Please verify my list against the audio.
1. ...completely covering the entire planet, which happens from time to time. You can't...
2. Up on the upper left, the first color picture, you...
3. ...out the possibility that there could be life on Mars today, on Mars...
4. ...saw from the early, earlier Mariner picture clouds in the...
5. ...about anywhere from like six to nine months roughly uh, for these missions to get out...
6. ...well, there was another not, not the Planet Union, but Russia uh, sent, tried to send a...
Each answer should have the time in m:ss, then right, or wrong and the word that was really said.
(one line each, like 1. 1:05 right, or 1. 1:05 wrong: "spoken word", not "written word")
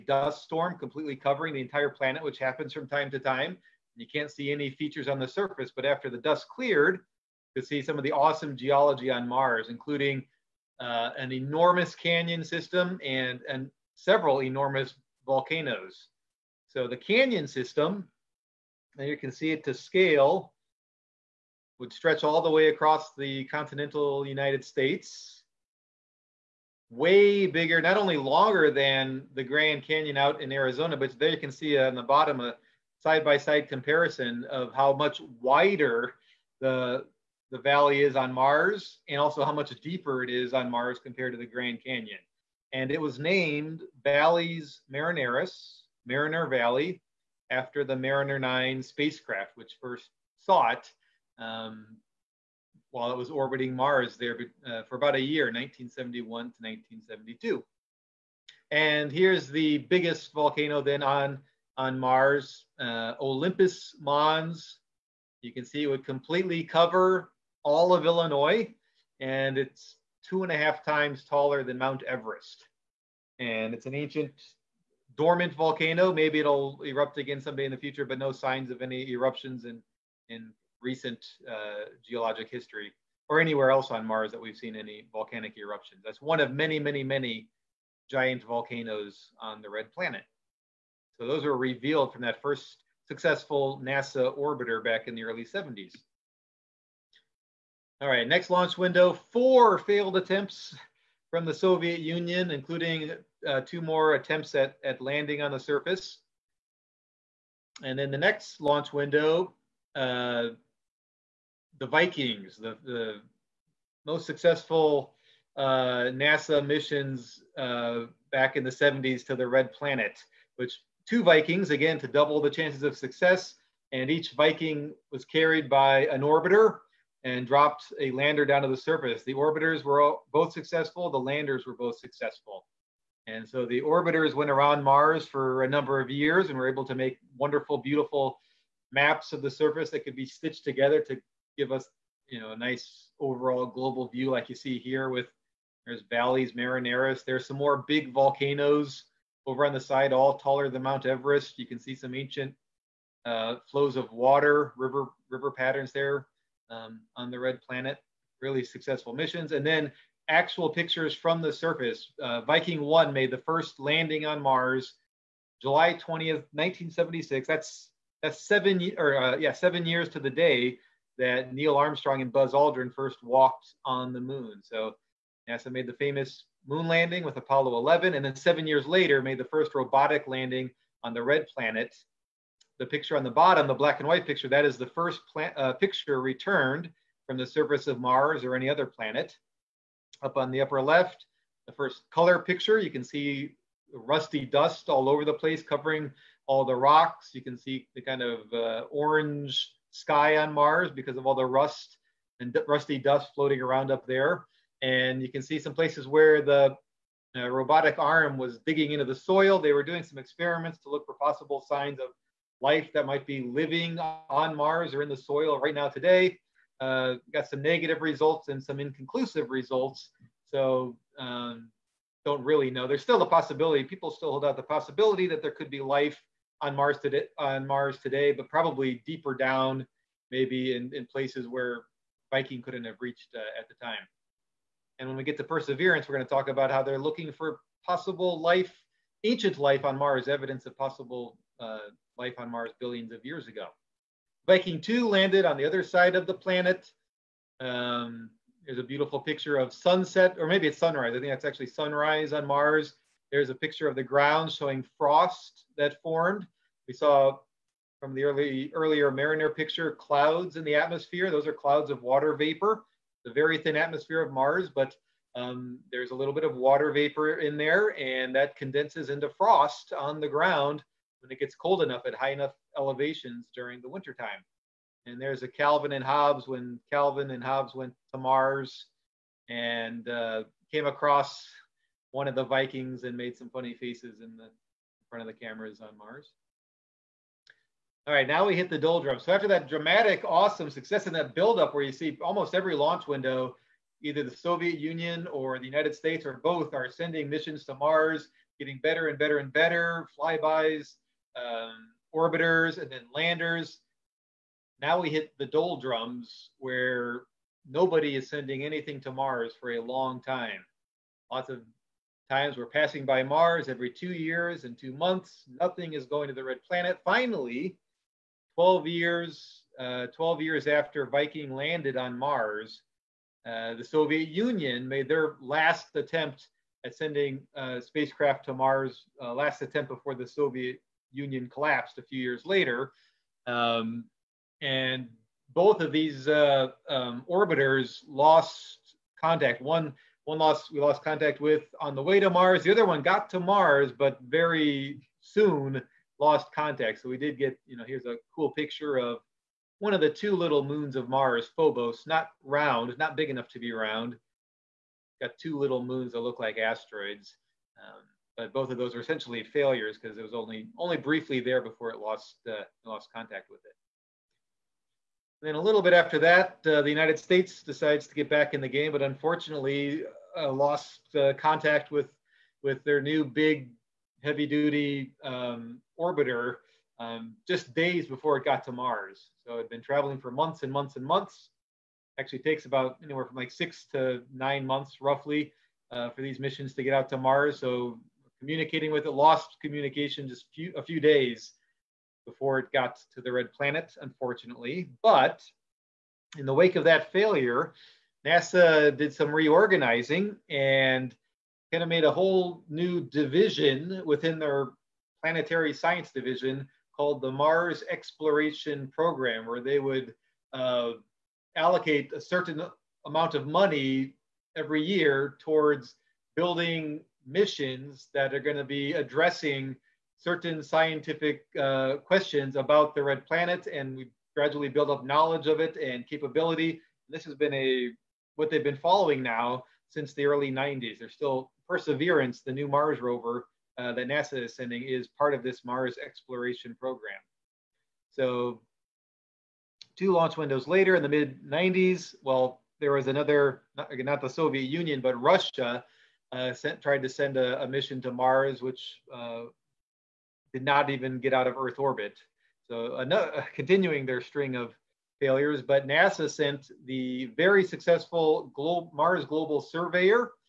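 1. 0:00 right
2. 3:10 right
3. 3:44 right
4. 4:16 right
5. 6:22 right
6. 7:22 wrong: "Soviet", not "Planet".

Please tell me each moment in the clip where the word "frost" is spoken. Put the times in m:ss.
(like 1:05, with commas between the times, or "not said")
4:14, 4:29.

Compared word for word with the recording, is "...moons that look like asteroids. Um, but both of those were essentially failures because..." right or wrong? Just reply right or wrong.
right.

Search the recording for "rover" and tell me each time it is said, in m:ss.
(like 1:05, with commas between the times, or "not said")
7:12.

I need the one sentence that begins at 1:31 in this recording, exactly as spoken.
So those were revealed from that first successful NASA orbiter back in the early 70s.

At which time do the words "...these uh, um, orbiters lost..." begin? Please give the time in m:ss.
5:35.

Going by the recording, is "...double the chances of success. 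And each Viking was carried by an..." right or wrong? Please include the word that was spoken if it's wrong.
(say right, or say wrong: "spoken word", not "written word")
right.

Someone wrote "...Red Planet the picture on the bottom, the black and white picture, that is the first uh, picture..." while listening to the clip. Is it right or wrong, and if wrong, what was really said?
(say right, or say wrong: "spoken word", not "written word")
right.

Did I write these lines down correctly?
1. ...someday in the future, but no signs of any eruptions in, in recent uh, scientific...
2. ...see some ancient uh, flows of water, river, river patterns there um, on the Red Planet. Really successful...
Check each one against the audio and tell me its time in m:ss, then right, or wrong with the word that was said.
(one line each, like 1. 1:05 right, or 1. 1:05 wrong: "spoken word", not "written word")
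1. 1:17 wrong: "geologic", not "scientific"
2. 2:31 right.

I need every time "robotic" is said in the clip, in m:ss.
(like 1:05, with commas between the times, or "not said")
2:59, 3:27.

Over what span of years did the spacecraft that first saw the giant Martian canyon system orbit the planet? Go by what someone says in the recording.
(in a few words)
1971 to 1972.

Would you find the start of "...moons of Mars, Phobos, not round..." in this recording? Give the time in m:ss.
5:50.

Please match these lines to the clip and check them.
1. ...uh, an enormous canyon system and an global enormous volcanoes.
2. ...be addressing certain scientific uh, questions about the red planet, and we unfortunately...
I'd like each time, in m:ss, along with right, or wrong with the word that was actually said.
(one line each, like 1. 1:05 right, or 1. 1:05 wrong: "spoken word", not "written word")
1. 0:10 wrong: "several", not "global"
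2. 6:58 wrong: "gradually", not "unfortunately".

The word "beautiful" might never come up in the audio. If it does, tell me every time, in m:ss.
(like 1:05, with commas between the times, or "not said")
2:17, 4:08.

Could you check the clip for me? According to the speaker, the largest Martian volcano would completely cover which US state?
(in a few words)
Illinois.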